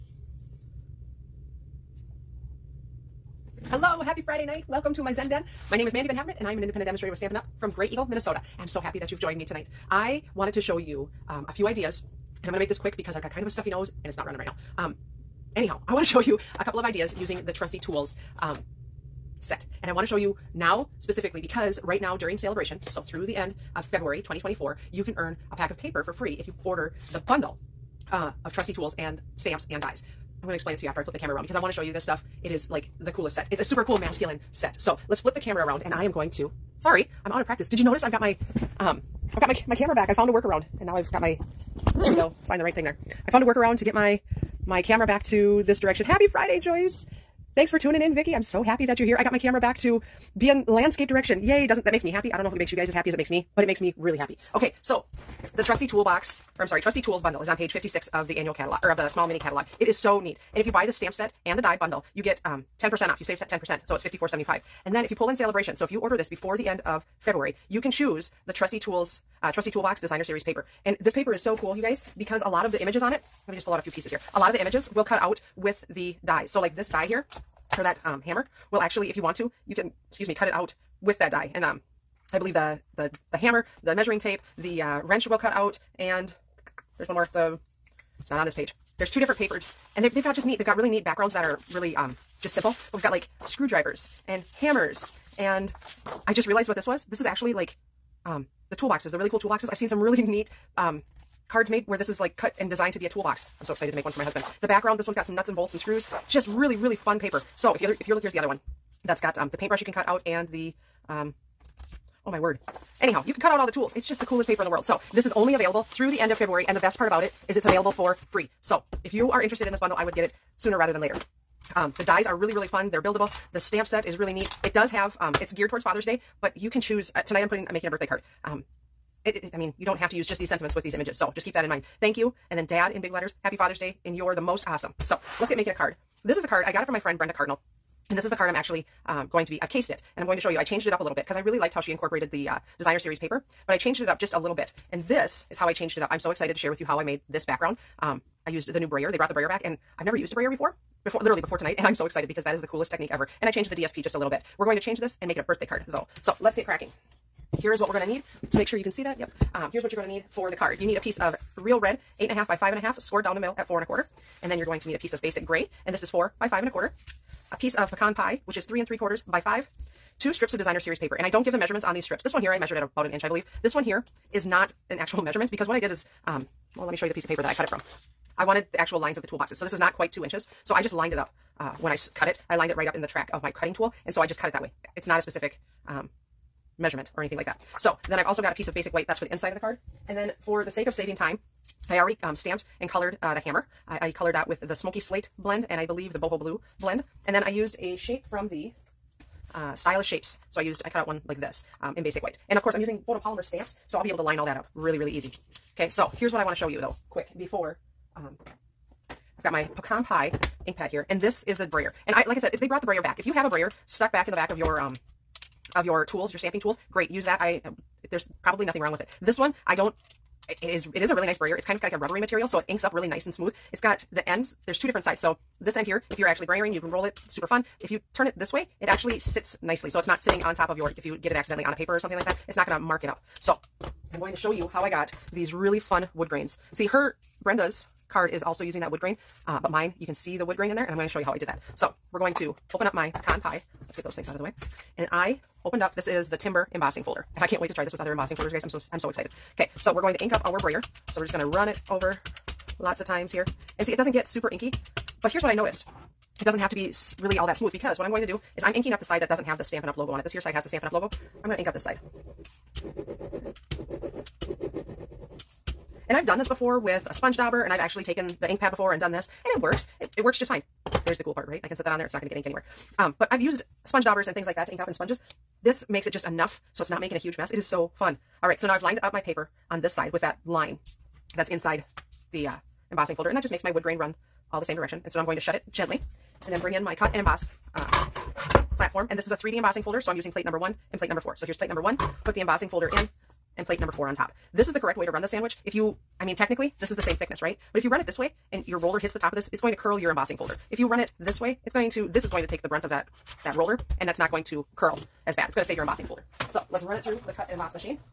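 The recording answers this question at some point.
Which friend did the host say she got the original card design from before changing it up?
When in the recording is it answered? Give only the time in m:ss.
2:17.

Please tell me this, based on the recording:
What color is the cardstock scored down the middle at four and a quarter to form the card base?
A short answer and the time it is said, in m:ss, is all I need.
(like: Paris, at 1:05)
Real red, at 2:41.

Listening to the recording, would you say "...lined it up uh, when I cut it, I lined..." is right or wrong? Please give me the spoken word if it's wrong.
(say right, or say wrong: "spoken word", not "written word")
right.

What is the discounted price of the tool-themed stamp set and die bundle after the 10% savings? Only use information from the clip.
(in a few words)
54.75.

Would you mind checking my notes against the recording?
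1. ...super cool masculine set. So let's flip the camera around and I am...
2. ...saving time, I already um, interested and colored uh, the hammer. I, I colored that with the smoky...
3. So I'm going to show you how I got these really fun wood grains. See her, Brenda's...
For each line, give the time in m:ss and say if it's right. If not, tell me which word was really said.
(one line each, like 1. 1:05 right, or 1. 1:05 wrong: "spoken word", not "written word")
1. 0:33 right
2. 3:10 wrong: "stamped", not "interested"
3. 3:53 right.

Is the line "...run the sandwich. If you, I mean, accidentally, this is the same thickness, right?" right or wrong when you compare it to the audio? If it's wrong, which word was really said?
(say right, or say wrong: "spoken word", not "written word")
wrong: "technically", not "accidentally".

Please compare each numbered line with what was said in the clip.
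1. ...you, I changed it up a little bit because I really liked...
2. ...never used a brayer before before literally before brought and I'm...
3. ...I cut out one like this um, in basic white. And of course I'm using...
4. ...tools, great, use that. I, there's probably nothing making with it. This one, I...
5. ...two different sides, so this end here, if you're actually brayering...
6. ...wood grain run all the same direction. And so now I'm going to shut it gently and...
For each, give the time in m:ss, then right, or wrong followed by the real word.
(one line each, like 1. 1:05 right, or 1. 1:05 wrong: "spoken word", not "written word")
1. 2:20 right
2. 2:30 wrong: "tonight", not "brought"
3. 3:20 right
4. 3:36 wrong: "wrong", not "making"
5. 3:44 right
6. 4:43 right.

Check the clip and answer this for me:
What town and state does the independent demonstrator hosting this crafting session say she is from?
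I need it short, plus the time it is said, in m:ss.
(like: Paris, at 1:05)
Grey Eagle, Minnesota, at 0:07.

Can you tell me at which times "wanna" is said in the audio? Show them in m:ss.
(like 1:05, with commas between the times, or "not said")
0:19, 3:26.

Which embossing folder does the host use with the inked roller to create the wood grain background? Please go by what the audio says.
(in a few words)
Timber.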